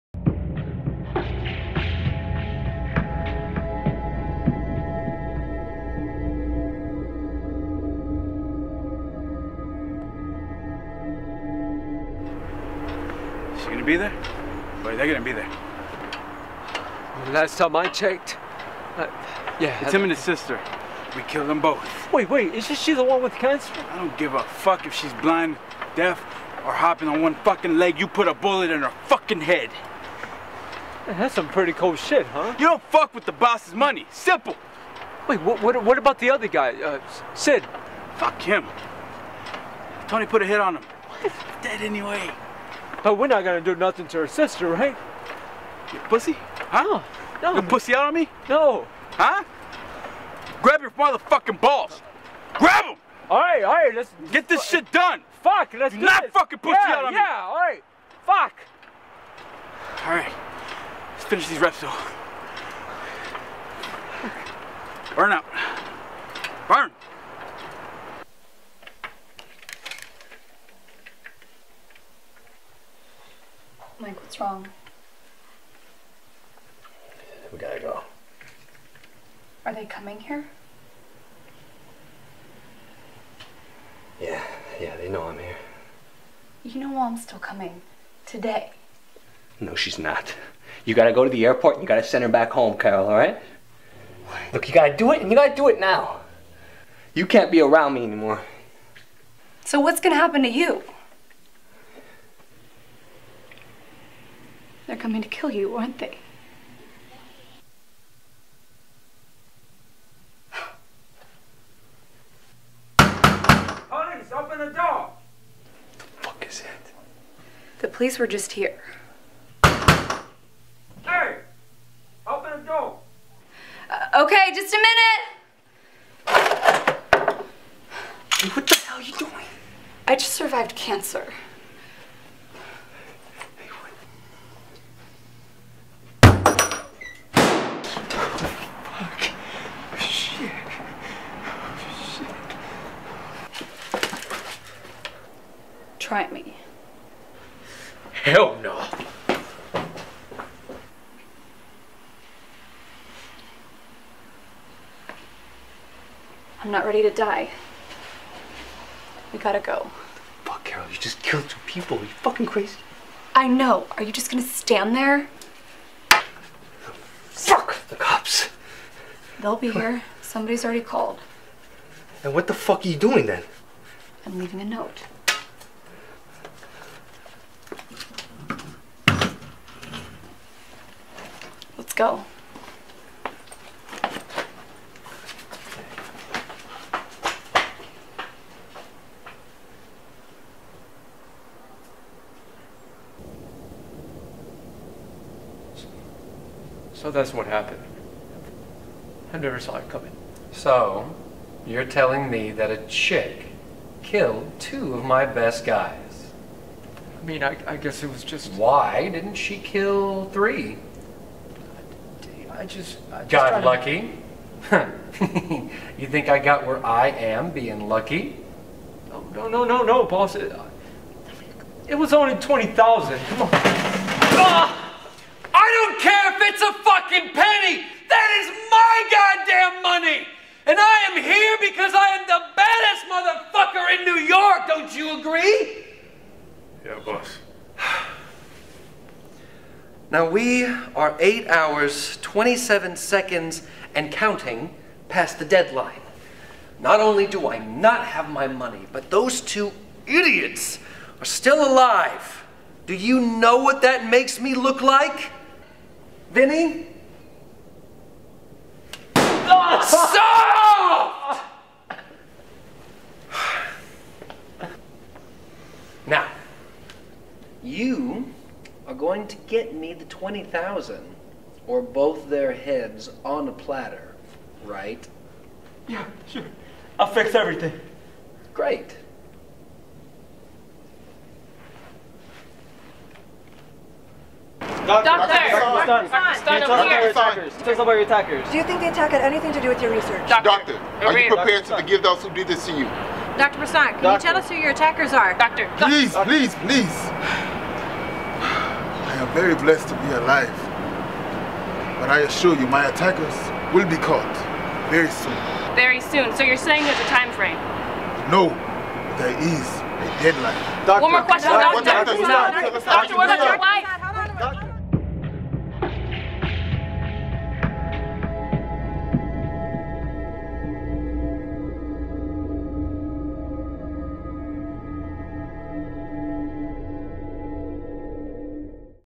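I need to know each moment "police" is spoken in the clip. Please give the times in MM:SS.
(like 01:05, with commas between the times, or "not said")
01:52, 01:57.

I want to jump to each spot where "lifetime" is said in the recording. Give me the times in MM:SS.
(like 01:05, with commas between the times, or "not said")
not said.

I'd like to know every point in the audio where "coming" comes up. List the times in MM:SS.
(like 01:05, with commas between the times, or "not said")
01:19, 01:27, 01:44, 03:19.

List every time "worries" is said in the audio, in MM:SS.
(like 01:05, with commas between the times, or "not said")
not said.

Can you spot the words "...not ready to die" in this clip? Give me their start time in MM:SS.
02:36.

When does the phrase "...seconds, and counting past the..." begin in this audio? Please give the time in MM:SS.
04:02.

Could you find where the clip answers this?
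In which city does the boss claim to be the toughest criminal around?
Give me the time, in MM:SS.
03:54.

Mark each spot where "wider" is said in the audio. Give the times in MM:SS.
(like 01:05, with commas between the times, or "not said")
not said.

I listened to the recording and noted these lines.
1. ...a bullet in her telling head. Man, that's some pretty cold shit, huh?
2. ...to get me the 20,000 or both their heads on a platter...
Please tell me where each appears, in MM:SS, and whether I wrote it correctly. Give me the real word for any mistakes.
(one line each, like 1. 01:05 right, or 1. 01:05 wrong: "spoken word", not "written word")
1. 00:28 wrong: "fucking", not "telling"
2. 04:29 right.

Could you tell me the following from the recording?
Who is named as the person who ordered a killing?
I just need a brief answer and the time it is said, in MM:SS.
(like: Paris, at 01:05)
Tony, at 00:40.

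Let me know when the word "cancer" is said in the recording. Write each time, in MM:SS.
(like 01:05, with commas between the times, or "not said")
00:23, 02:10.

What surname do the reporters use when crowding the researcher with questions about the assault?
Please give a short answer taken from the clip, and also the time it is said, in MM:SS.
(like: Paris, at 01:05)
Prasad, at 04:53.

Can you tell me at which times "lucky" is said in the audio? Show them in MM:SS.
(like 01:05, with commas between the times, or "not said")
03:33, 03:37.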